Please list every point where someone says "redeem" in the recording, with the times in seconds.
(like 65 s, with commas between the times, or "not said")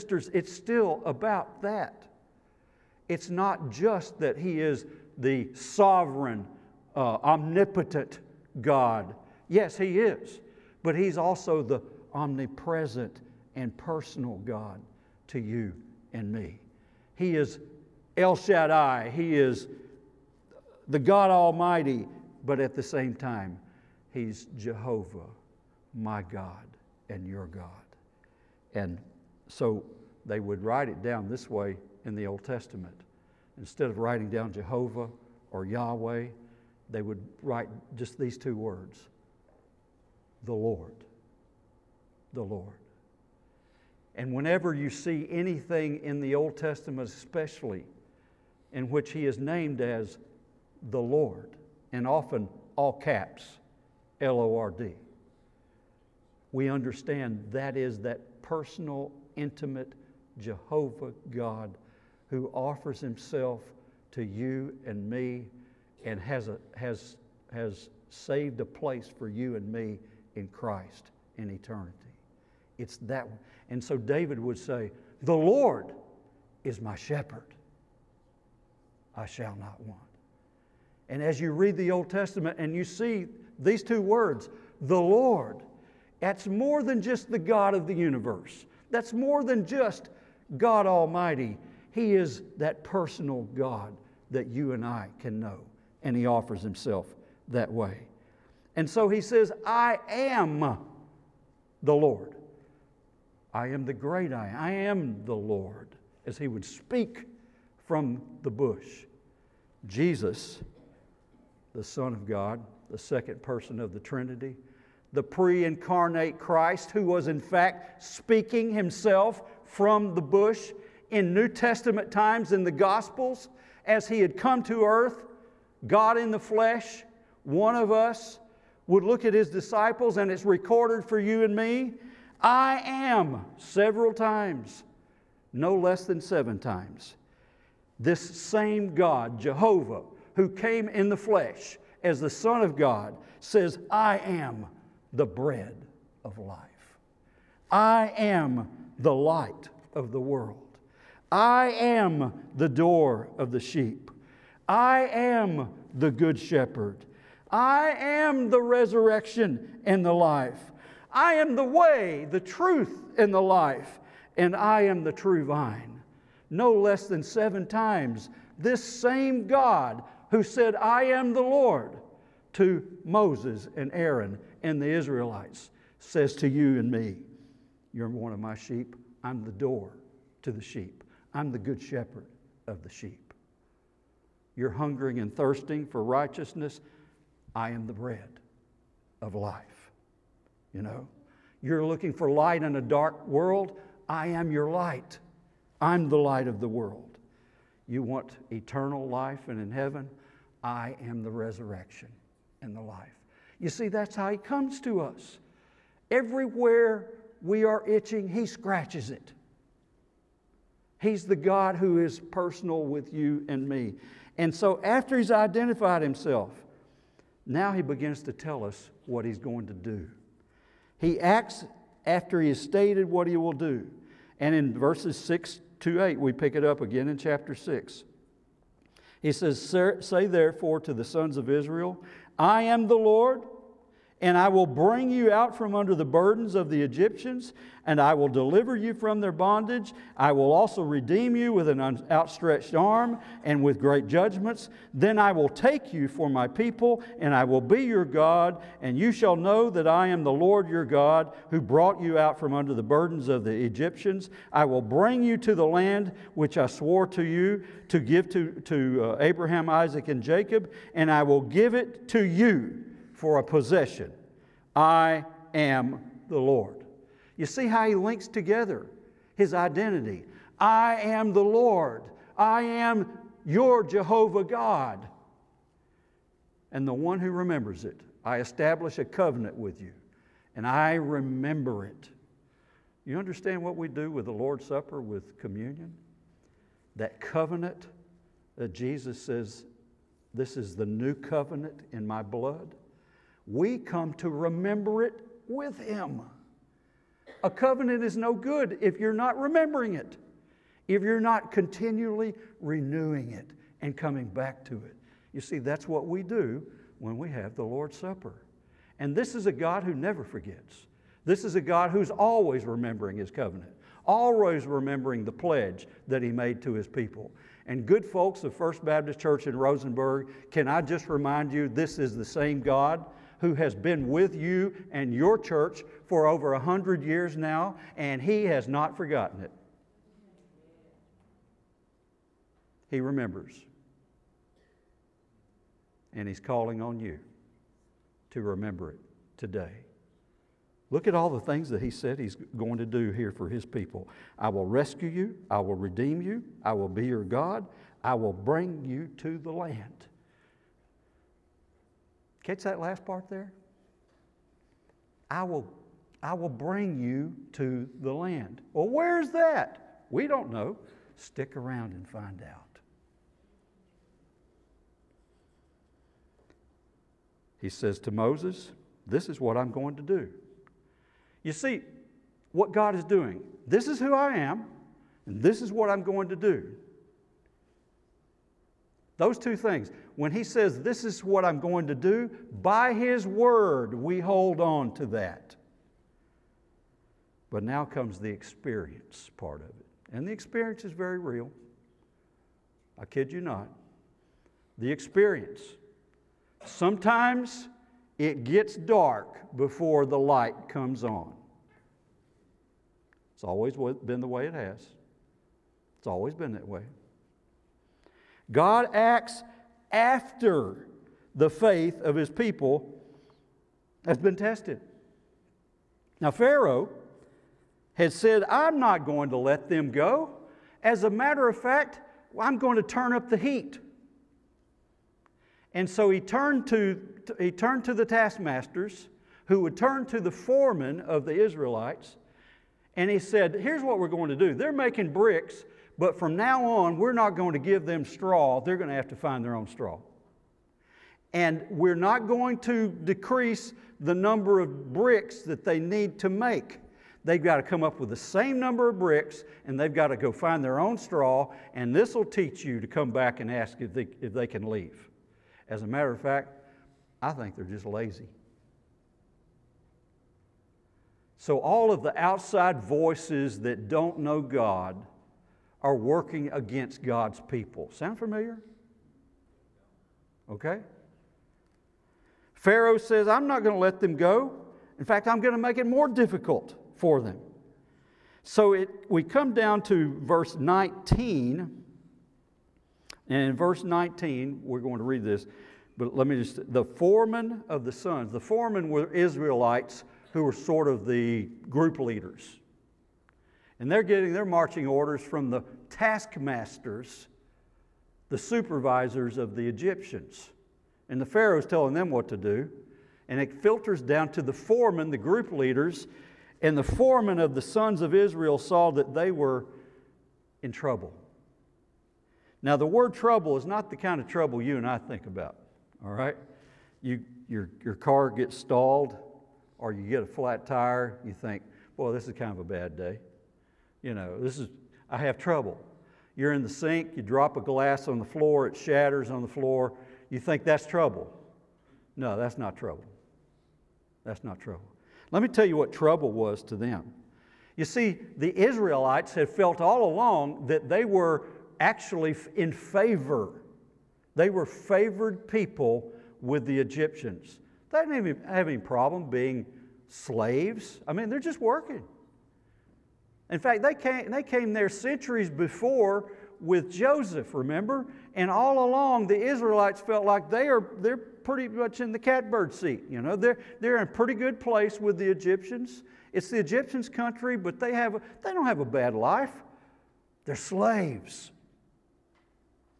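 240 s, 345 s.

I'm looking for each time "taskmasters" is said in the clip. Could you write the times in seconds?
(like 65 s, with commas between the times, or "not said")
428 s, 495 s.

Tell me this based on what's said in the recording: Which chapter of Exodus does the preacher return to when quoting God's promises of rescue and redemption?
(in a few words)
chapter 6.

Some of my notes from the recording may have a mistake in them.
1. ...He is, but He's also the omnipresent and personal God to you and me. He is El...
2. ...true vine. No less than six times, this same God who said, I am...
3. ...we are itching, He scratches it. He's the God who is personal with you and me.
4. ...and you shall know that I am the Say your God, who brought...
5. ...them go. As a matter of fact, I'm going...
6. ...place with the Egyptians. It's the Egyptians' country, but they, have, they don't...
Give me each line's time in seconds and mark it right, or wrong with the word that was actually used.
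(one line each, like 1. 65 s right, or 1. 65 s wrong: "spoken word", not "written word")
1. 9 s right
2. 165 s wrong: "seven", not "six"
3. 207 s right
4. 248 s wrong: "Lord", not "Say"
5. 419 s right
6. 564 s right.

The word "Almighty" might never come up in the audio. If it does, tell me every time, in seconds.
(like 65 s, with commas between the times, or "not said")
21 s, 90 s.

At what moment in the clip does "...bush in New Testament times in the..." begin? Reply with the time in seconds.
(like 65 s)
120 s.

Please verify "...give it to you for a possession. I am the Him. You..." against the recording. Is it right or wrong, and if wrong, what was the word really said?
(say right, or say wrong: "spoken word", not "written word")
wrong: "Lord", not "Him".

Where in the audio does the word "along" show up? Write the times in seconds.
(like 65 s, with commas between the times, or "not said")
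540 s, 558 s.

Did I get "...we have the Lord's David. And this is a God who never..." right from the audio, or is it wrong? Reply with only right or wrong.
wrong.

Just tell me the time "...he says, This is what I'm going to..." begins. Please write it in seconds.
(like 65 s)
380 s.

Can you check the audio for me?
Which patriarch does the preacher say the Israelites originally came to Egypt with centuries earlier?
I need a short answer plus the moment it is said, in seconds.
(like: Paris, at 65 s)
Joseph, at 556 s.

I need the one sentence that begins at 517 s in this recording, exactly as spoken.
You, your, your car gets stalled or you get a flat tire, you think, boy, this is kind of a bad day.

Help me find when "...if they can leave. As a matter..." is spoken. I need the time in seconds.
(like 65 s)
454 s.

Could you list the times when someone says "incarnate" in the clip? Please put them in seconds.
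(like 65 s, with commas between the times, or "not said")
115 s.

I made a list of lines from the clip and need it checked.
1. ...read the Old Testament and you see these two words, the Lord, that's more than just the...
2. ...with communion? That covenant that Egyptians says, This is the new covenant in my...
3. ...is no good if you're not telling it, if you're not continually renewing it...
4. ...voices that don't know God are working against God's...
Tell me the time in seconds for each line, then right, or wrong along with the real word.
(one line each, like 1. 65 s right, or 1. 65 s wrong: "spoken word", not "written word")
1. 81 s right
2. 285 s wrong: "Jesus", not "Egyptians"
3. 298 s wrong: "remembering", not "telling"
4. 462 s right.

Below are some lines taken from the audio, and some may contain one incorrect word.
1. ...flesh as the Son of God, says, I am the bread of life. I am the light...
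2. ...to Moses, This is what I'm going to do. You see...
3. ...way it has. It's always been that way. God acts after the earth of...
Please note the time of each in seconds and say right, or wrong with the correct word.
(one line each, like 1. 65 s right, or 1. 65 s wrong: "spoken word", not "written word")
1. 141 s right
2. 368 s right
3. 404 s wrong: "faith", not "earth".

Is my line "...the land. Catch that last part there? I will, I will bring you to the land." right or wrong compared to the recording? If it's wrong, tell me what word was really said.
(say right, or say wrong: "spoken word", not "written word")
right.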